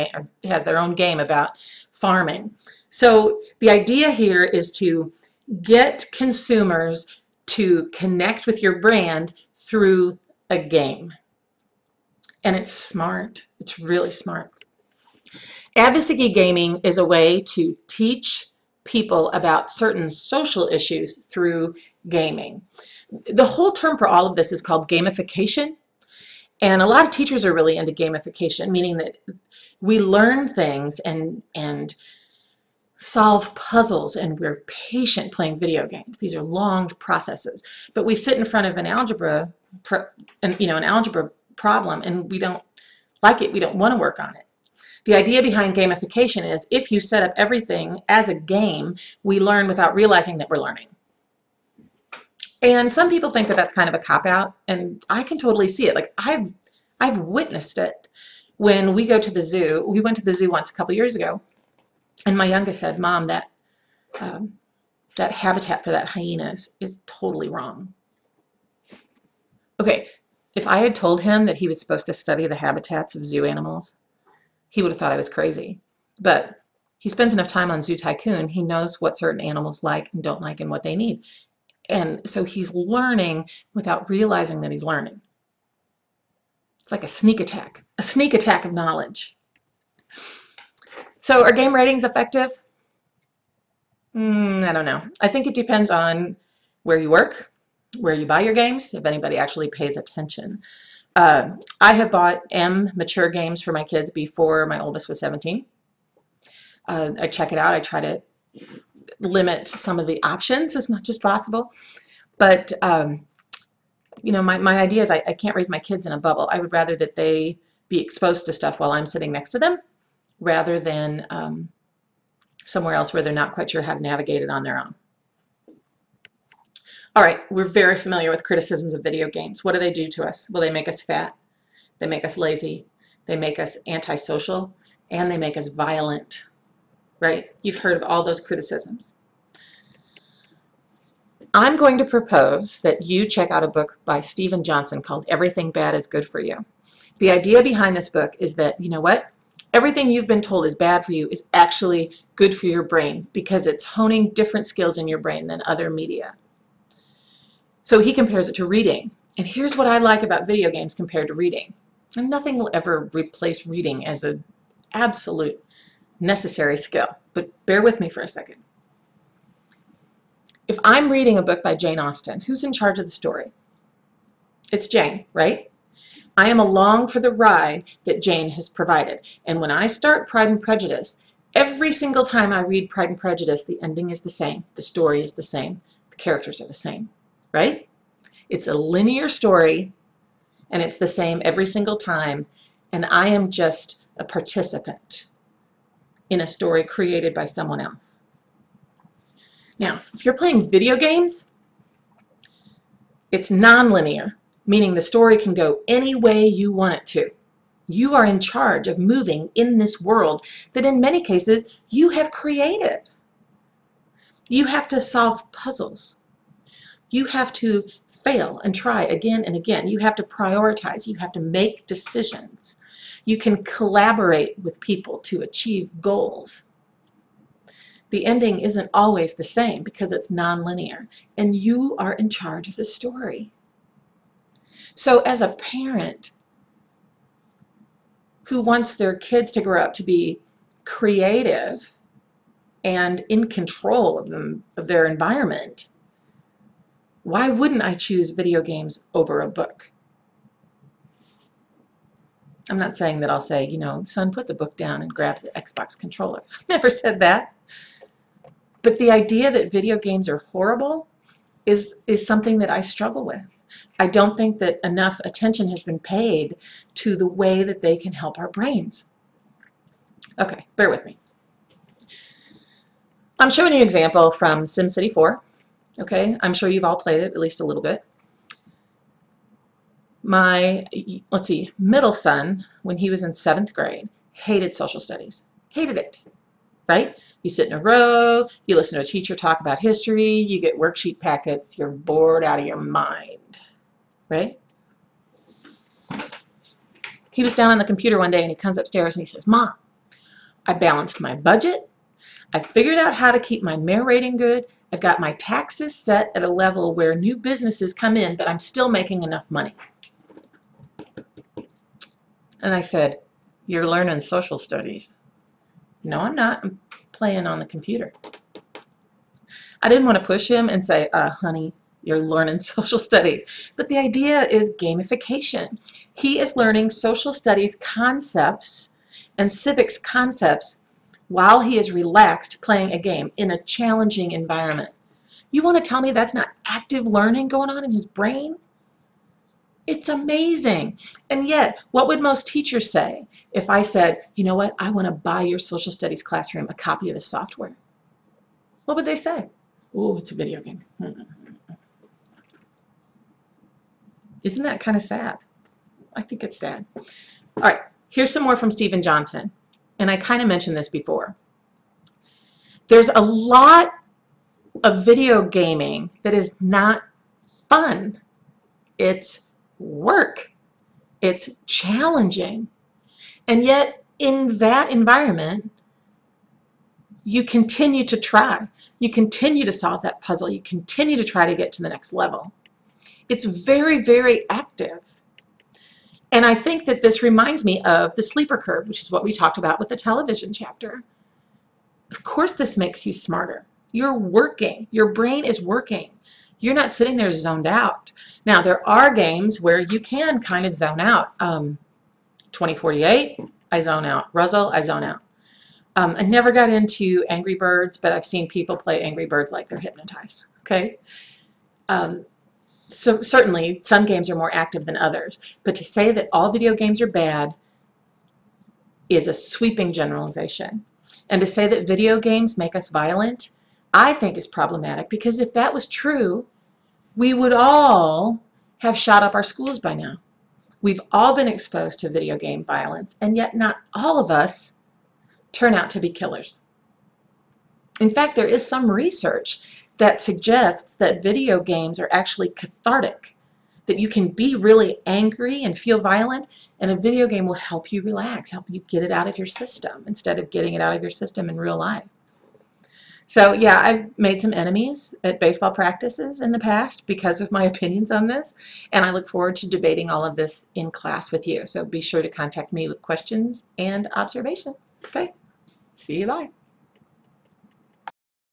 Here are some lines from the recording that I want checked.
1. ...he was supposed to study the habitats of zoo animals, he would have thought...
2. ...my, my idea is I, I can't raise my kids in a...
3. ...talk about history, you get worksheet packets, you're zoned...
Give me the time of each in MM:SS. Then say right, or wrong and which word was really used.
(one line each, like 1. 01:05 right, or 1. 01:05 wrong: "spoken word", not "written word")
1. 01:11 right
2. 01:54 right
3. 04:49 wrong: "bored", not "zoned".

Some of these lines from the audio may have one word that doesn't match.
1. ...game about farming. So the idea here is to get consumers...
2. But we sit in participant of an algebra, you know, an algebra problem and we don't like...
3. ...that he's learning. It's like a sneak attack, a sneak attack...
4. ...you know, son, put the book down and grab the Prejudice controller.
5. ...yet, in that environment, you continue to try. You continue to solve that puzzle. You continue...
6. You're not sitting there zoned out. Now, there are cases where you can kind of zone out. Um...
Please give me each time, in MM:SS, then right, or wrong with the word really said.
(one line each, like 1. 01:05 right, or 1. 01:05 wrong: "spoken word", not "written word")
1. 00:00 right
2. 00:37 wrong: "front", not "participant"
3. 01:24 right
4. 04:13 wrong: "Xbox", not "Prejudice"
5. 06:13 right
6. 06:36 wrong: "games", not "cases".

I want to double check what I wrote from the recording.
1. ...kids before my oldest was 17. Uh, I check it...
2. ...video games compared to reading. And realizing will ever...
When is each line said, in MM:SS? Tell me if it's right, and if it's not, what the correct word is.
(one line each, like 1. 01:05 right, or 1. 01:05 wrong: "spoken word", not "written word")
1. 01:43 right
2. 02:40 wrong: "nothing", not "realizing".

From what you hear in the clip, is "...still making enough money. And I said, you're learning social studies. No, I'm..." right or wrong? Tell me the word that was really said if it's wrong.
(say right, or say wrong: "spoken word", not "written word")
right.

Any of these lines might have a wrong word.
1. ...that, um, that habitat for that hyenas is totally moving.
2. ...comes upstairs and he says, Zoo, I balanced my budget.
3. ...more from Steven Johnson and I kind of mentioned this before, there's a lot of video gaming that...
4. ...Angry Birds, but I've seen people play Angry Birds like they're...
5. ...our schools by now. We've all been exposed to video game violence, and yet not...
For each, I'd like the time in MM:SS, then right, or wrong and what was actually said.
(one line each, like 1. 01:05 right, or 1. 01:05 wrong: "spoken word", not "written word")
1. 01:03 wrong: "wrong", not "moving"
2. 04:58 wrong: "Mom", not "Zoo"
3. 05:58 right
4. 06:47 right
5. 07:09 right.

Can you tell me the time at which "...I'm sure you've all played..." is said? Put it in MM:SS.
04:36.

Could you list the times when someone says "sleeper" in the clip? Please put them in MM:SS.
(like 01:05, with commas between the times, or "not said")
06:28.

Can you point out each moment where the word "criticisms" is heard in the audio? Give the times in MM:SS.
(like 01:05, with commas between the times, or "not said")
02:08, 02:18.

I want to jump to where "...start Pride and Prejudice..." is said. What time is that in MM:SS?
02:59.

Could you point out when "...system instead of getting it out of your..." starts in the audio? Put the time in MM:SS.
07:29.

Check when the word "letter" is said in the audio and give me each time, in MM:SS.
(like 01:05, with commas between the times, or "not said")
not said.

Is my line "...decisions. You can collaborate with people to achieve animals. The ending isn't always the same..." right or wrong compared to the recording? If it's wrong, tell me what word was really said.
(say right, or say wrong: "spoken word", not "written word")
wrong: "goals", not "animals".